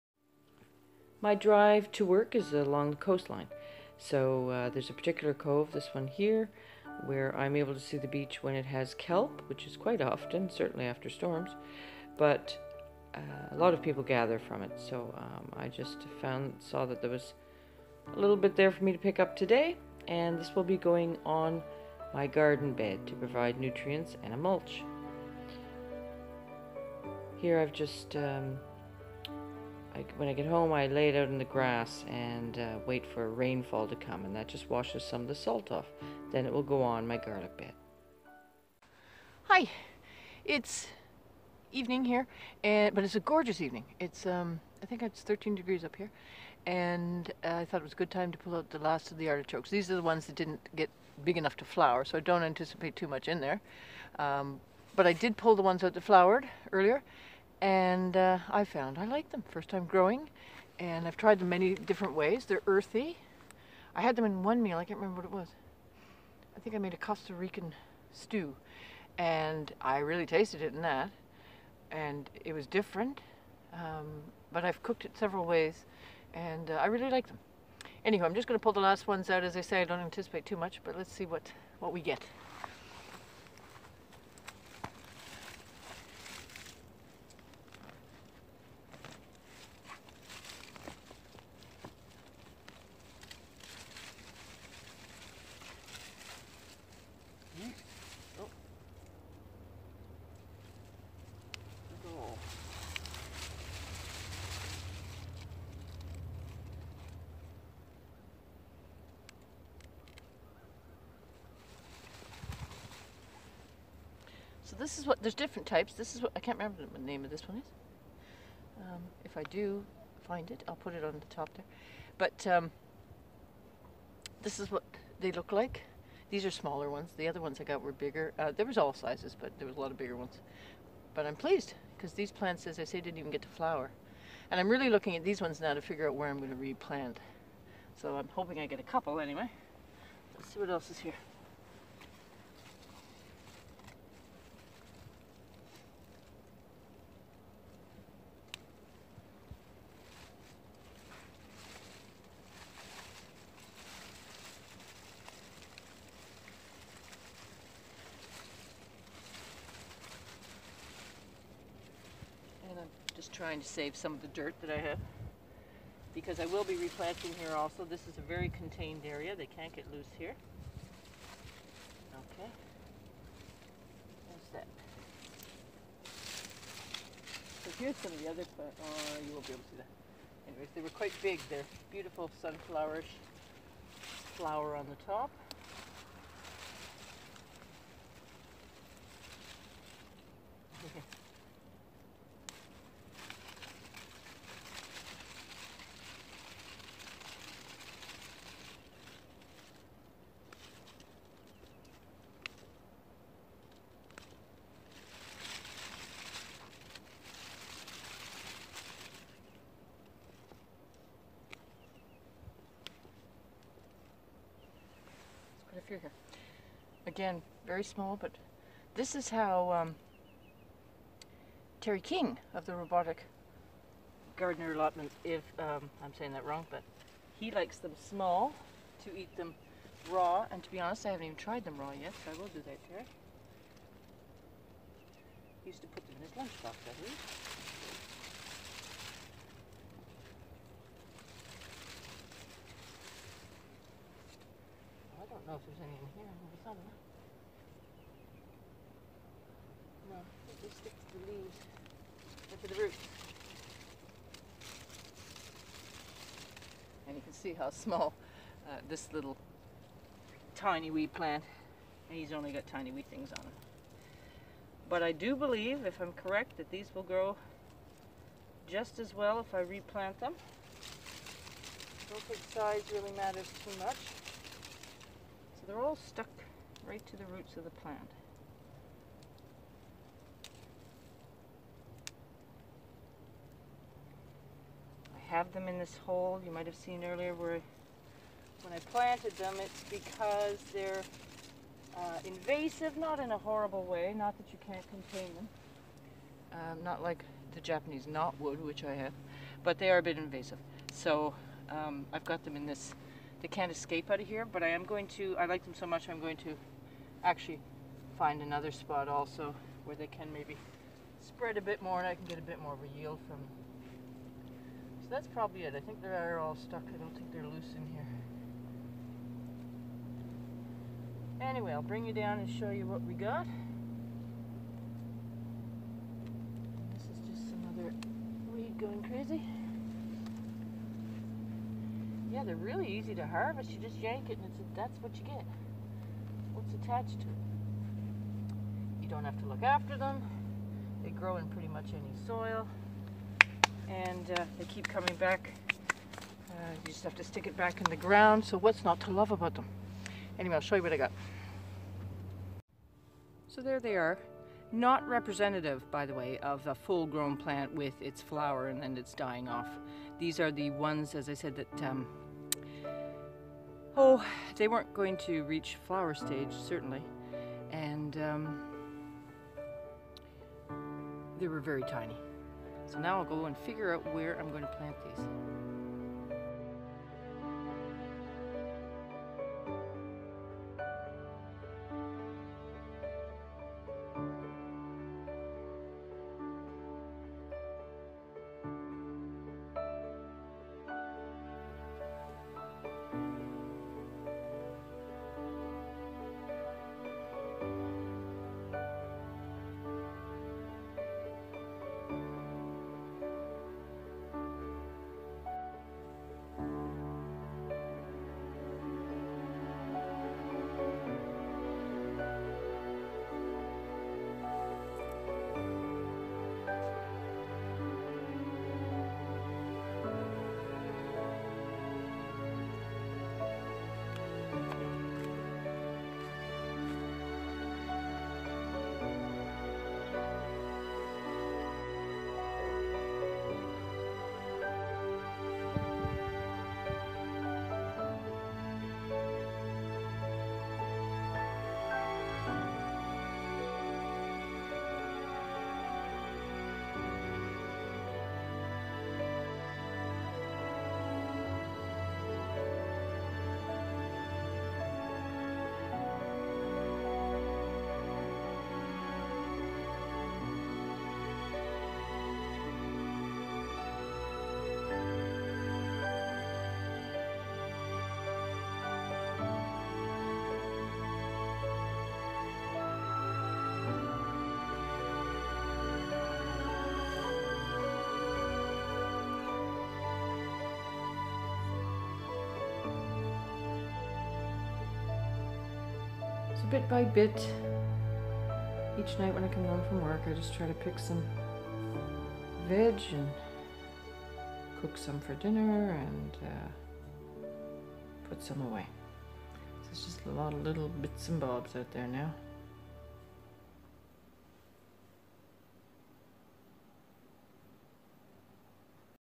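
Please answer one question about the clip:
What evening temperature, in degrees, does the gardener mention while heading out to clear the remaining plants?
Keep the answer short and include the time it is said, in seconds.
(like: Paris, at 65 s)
13, at 45 s.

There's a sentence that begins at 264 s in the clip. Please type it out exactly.
But I do believe, if I'm correct, that these will grow just as well if I replant them.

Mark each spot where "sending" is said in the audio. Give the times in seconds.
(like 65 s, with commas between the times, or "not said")
not said.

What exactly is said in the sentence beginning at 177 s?
So here's some of the other plants.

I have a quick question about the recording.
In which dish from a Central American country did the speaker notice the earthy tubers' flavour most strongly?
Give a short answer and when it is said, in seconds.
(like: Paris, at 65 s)
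Costa Rican stew, at 66 s.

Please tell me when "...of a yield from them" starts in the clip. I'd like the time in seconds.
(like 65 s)
312 s.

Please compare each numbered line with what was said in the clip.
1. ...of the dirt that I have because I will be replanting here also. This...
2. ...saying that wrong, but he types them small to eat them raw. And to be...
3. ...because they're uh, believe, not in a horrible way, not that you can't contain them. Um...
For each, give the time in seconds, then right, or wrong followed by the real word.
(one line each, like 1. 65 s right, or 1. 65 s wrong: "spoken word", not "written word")
1. 164 s right
2. 226 s wrong: "likes", not "types"
3. 289 s wrong: "invasive", not "believe".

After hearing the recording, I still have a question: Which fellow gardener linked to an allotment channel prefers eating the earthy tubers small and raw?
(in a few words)
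Terry King.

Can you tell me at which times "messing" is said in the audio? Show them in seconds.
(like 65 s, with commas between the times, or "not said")
not said.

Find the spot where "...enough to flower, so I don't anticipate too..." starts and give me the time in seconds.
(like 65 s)
51 s.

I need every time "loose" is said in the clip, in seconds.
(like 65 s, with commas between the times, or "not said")
169 s, 317 s.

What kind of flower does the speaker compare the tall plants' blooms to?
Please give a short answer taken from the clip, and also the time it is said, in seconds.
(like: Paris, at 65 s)
sunflowerish, at 182 s.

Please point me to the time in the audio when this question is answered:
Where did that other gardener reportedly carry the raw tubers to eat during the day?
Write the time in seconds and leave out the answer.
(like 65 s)
236 s.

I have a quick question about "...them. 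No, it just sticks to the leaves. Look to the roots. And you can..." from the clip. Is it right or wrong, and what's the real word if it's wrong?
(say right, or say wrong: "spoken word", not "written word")
right.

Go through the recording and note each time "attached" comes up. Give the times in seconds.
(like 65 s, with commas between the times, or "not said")
336 s.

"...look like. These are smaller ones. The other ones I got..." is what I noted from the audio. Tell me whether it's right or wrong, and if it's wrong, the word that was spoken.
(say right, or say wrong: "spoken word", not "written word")
right.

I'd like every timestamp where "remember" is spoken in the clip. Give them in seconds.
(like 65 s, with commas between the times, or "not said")
64 s, 116 s.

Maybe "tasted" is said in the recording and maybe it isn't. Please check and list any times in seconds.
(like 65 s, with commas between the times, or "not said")
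70 s.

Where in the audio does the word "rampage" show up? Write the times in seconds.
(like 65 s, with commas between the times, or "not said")
not said.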